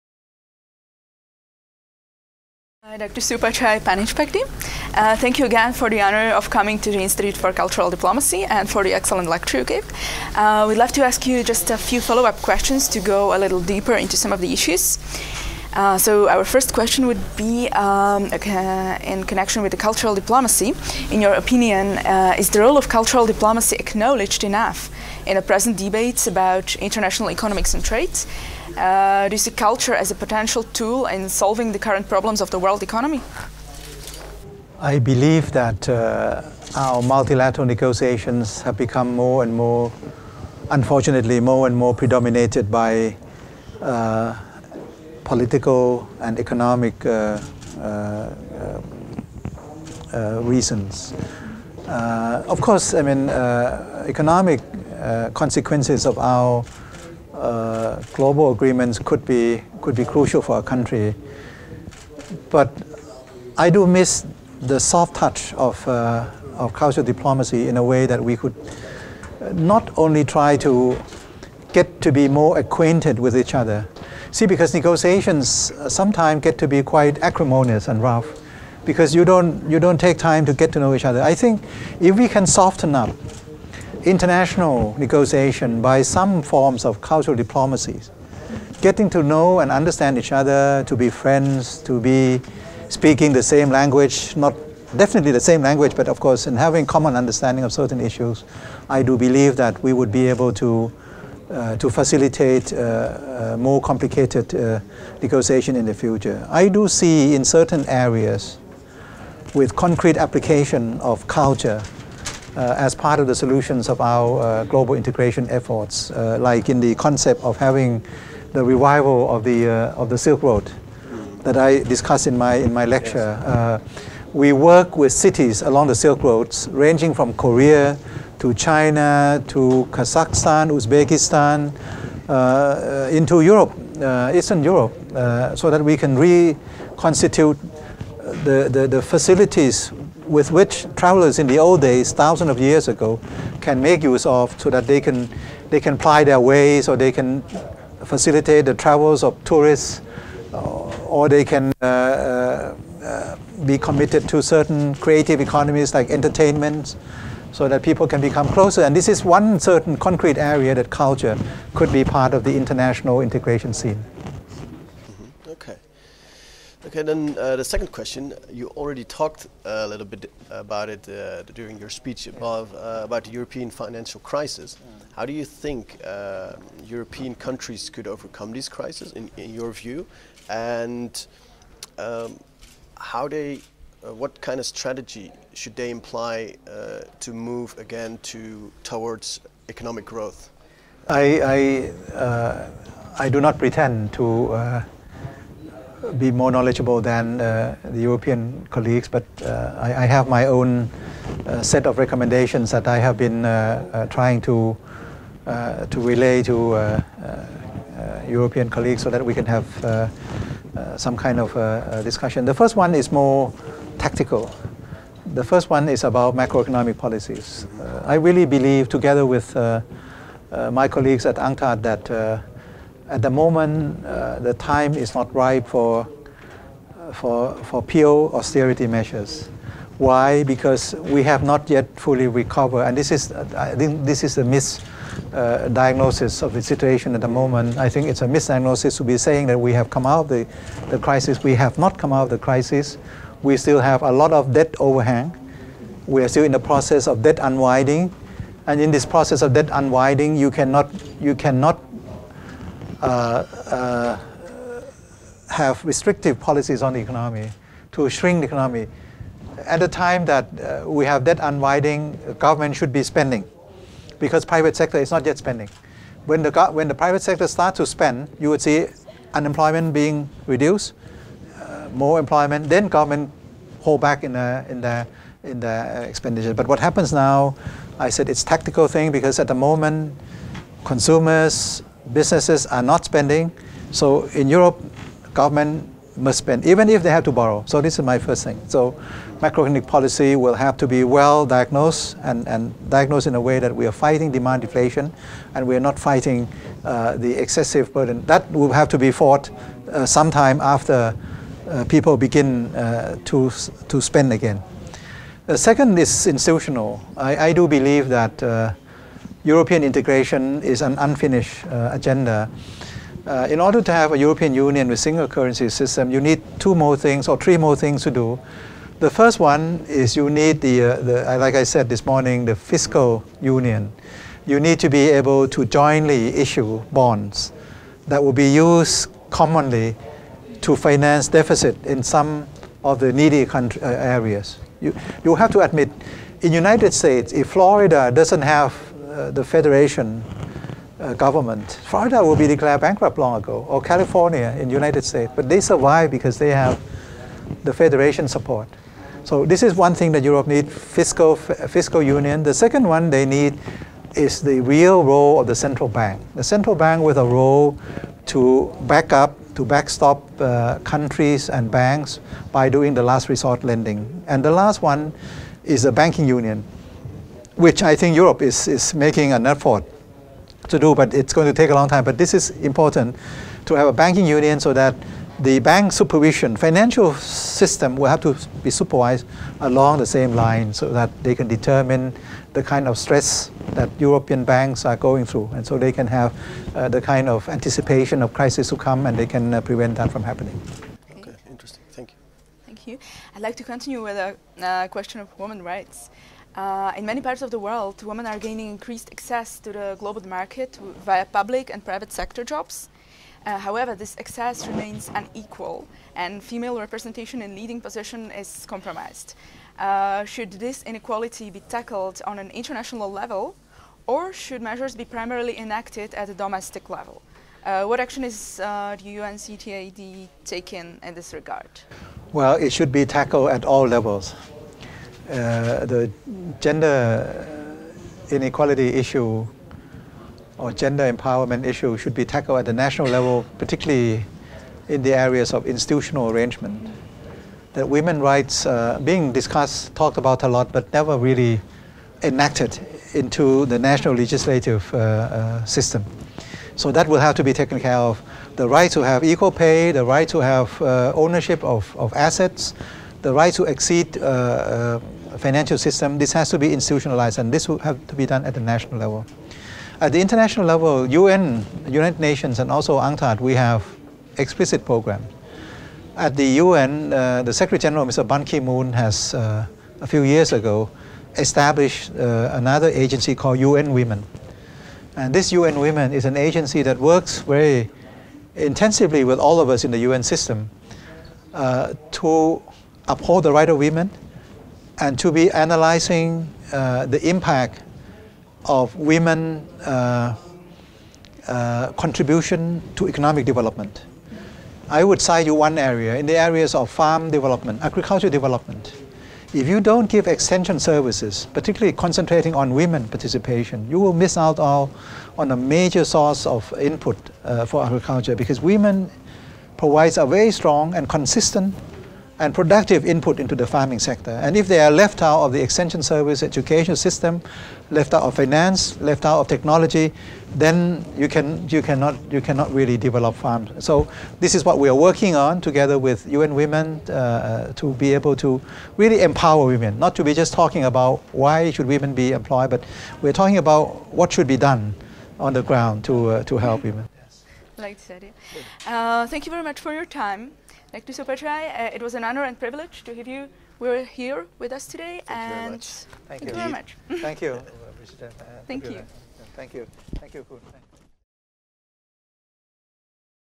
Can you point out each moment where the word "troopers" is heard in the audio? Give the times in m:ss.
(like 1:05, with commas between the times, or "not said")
not said.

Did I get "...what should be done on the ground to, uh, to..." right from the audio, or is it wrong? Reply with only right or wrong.
right.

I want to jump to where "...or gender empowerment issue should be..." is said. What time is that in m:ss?
7:10.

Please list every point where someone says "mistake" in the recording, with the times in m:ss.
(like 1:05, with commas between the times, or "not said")
not said.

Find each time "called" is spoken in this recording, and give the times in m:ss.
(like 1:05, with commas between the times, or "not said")
7:53.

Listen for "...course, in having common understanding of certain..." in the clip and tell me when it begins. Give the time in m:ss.
1:36.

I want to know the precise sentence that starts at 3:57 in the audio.
I think it's a misdiagnosis to be saying that we have come out of the, the crisis.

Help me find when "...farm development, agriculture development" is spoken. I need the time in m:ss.
8:16.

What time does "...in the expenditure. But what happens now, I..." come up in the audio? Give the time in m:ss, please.
4:35.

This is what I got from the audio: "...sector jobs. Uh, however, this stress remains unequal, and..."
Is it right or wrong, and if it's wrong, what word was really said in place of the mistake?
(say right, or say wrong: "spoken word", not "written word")
wrong: "access", not "stress".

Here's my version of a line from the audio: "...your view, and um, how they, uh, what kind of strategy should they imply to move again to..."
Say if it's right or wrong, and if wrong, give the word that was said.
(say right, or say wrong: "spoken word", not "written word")
right.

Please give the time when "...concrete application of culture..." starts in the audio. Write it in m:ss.
1:49.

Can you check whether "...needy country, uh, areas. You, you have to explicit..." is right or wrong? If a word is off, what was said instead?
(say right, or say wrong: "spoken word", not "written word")
wrong: "admit", not "explicit".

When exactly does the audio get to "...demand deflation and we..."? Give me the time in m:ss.
4:54.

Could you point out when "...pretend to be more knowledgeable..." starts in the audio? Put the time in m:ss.
3:13.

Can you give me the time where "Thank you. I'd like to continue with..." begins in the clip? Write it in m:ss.
6:32.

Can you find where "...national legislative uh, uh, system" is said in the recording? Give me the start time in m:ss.
7:23.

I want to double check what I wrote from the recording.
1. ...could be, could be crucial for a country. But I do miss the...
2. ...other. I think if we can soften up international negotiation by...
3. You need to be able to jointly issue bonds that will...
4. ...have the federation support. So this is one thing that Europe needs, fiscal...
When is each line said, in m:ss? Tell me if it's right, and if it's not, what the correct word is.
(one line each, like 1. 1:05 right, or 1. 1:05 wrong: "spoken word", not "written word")
1. 0:58 right
2. 1:21 right
3. 5:24 right
4. 5:46 right.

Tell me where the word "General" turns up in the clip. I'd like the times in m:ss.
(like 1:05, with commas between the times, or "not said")
7:47.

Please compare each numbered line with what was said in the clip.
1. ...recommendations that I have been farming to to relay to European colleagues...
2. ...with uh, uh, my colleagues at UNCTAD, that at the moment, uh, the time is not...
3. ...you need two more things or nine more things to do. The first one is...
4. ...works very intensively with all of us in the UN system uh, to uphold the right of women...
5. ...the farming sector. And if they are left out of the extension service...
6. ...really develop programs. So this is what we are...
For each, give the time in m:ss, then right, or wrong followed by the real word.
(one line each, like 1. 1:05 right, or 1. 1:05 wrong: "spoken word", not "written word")
1. 3:21 wrong: "trying", not "farming"
2. 3:39 right
3. 5:16 wrong: "three", not "nine"
4. 7:56 right
5. 8:33 right
6. 8:42 wrong: "farms", not "programs".